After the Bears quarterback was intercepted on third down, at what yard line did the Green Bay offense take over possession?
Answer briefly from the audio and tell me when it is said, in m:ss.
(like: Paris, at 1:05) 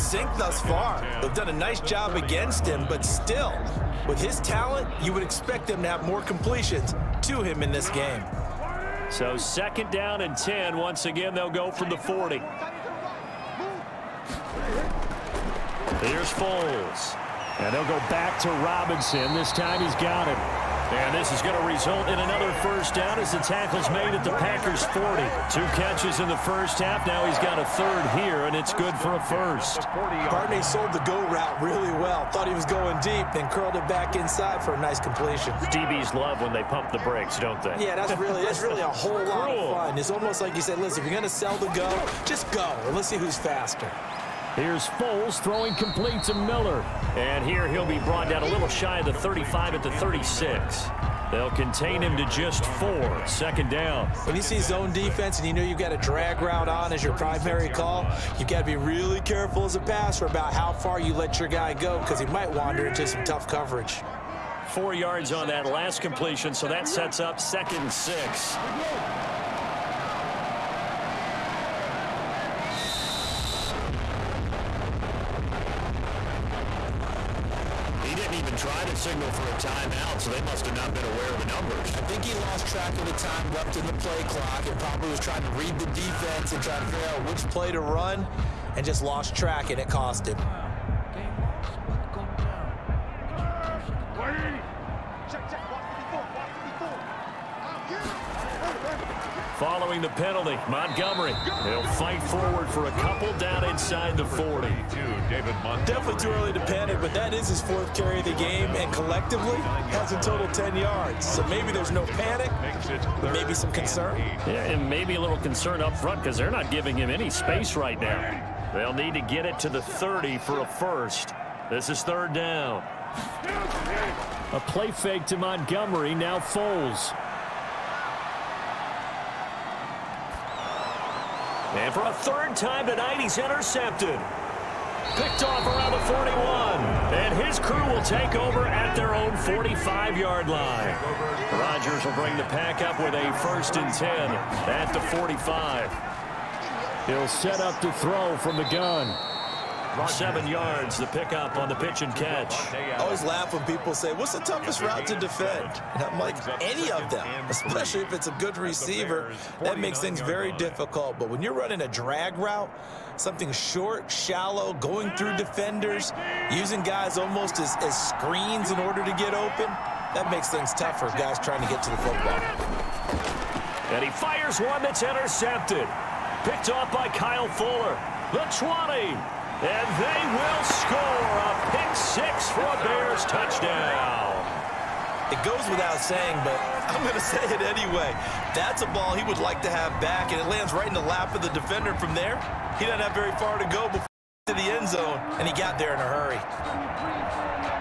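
45, at 2:19.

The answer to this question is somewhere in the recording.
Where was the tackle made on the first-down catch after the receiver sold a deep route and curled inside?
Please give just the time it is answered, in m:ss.
0:24.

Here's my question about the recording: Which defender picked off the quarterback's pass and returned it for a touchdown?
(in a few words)
Kyle Fuller.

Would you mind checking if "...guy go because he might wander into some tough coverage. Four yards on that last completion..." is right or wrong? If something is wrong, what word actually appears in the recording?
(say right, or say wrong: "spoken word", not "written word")
right.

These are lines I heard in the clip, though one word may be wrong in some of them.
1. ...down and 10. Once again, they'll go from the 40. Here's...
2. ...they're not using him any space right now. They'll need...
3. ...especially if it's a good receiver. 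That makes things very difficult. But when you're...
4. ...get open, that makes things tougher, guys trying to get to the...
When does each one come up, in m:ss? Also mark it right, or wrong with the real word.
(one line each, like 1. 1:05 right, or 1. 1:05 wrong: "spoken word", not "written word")
1. 0:09 right
2. 1:56 wrong: "giving", not "using"
3. 2:37 right
4. 2:49 right.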